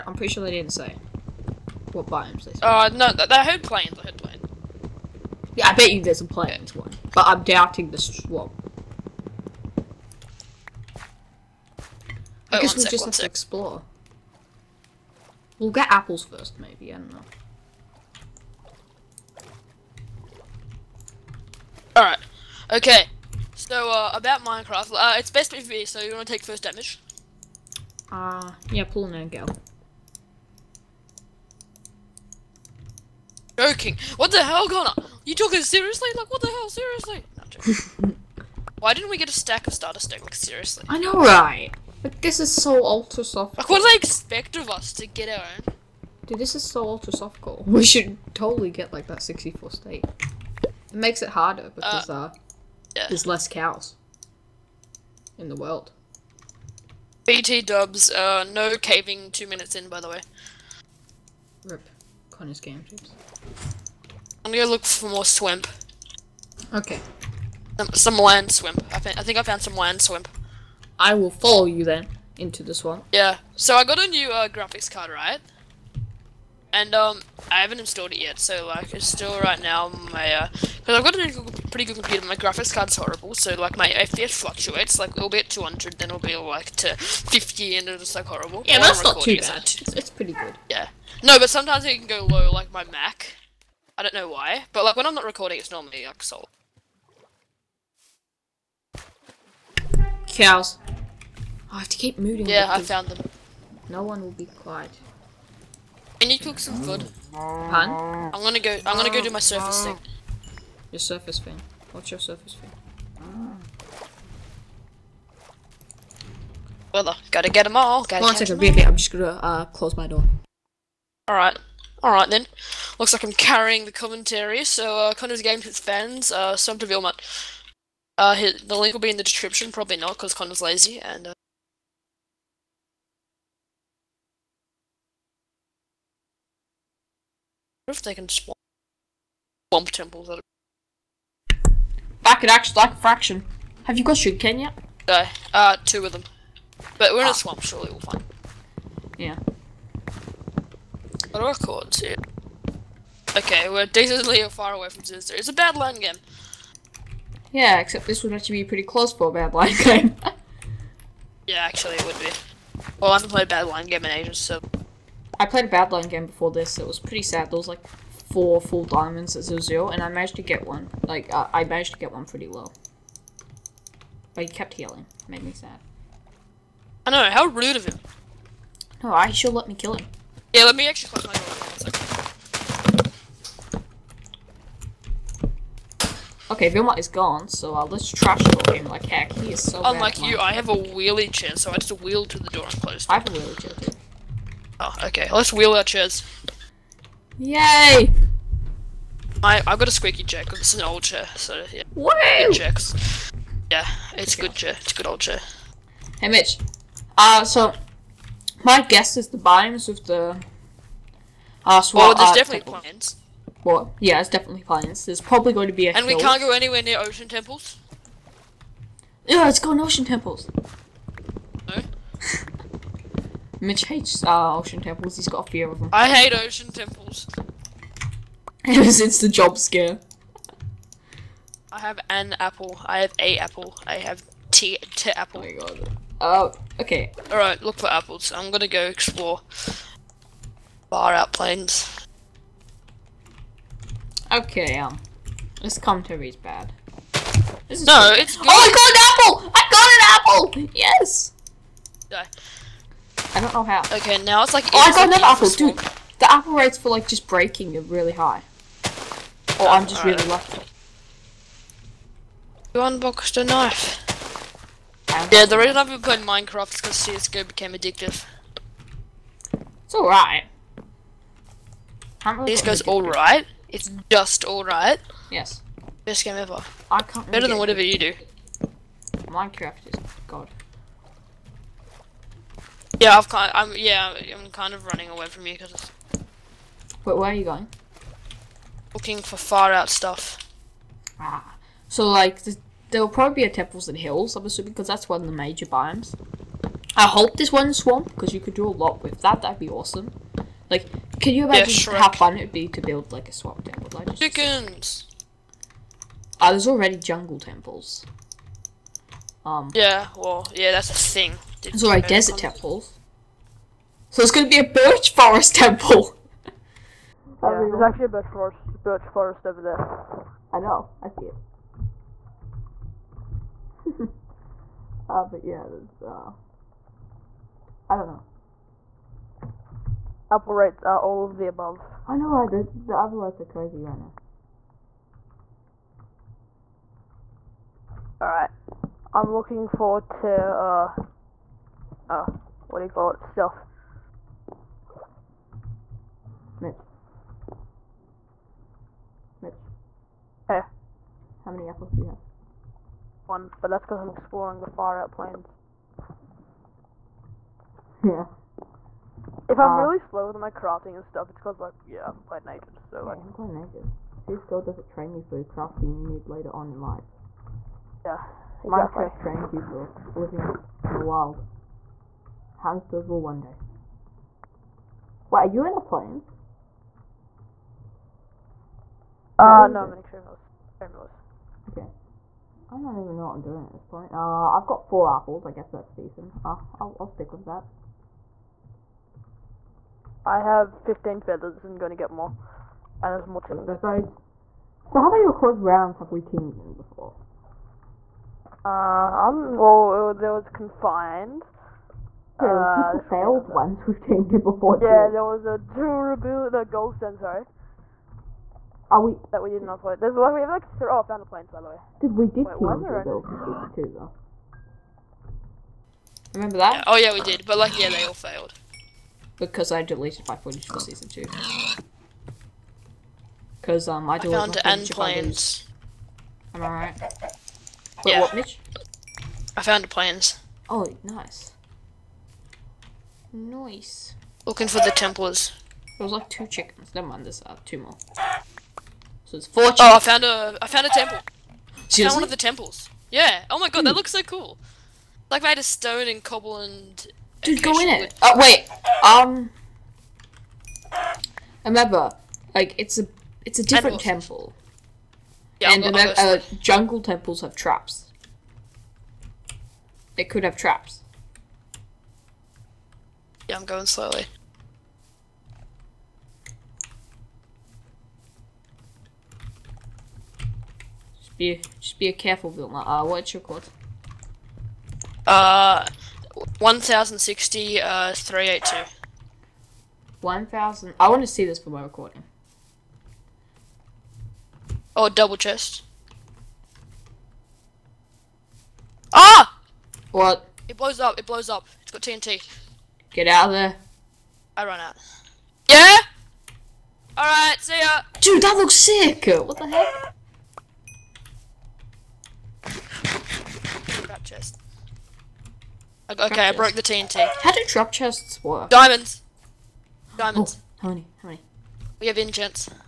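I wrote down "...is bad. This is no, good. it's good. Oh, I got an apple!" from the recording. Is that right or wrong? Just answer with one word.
right.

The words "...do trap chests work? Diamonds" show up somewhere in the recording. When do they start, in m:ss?
8:27.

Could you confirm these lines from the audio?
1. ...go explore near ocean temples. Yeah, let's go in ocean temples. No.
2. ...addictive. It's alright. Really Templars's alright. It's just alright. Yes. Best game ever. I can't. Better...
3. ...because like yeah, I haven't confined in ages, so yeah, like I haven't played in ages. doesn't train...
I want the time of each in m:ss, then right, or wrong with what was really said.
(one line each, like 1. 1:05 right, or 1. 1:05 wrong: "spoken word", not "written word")
1. 3:36 wrong: "anywhere", not "explore"
2. 4:27 wrong: "CSGO", not "Templars"
3. 6:01 wrong: "played", not "confined".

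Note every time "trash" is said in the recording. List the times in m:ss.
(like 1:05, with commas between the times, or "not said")
3:08.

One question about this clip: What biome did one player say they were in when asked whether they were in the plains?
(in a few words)
Extreme hills.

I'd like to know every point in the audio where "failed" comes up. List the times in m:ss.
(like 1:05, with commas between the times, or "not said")
6:43, 6:58.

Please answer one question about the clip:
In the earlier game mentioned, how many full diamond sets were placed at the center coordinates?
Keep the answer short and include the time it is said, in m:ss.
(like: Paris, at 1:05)
4, at 2:48.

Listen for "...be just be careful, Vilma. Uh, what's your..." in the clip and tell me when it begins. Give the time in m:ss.
7:51.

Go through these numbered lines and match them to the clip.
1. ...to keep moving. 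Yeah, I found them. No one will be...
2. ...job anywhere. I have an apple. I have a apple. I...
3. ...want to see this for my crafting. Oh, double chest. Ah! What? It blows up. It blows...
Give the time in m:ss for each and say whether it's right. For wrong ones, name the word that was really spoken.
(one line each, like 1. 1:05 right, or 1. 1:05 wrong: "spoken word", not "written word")
1. 1:41 right
2. 3:49 wrong: "scare", not "anywhere"
3. 8:01 wrong: "recording", not "crafting".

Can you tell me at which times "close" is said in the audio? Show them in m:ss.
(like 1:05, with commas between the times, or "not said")
1:59, 2:38, 3:01, 3:12.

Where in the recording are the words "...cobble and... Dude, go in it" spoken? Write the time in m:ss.
7:26.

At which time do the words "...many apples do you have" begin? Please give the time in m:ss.
5:51.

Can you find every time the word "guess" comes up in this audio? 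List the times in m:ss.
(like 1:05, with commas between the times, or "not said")
0:12, 3:28, 5:11, 6:25.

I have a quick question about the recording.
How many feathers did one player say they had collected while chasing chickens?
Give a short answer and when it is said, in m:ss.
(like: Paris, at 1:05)
15, at 6:30.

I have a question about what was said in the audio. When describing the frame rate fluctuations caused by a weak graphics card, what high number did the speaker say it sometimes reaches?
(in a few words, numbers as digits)
200.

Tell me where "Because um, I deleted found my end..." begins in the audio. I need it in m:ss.
7:03.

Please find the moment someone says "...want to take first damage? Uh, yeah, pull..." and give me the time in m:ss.
0:26.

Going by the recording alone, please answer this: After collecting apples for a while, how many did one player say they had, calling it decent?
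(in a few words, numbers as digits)
4.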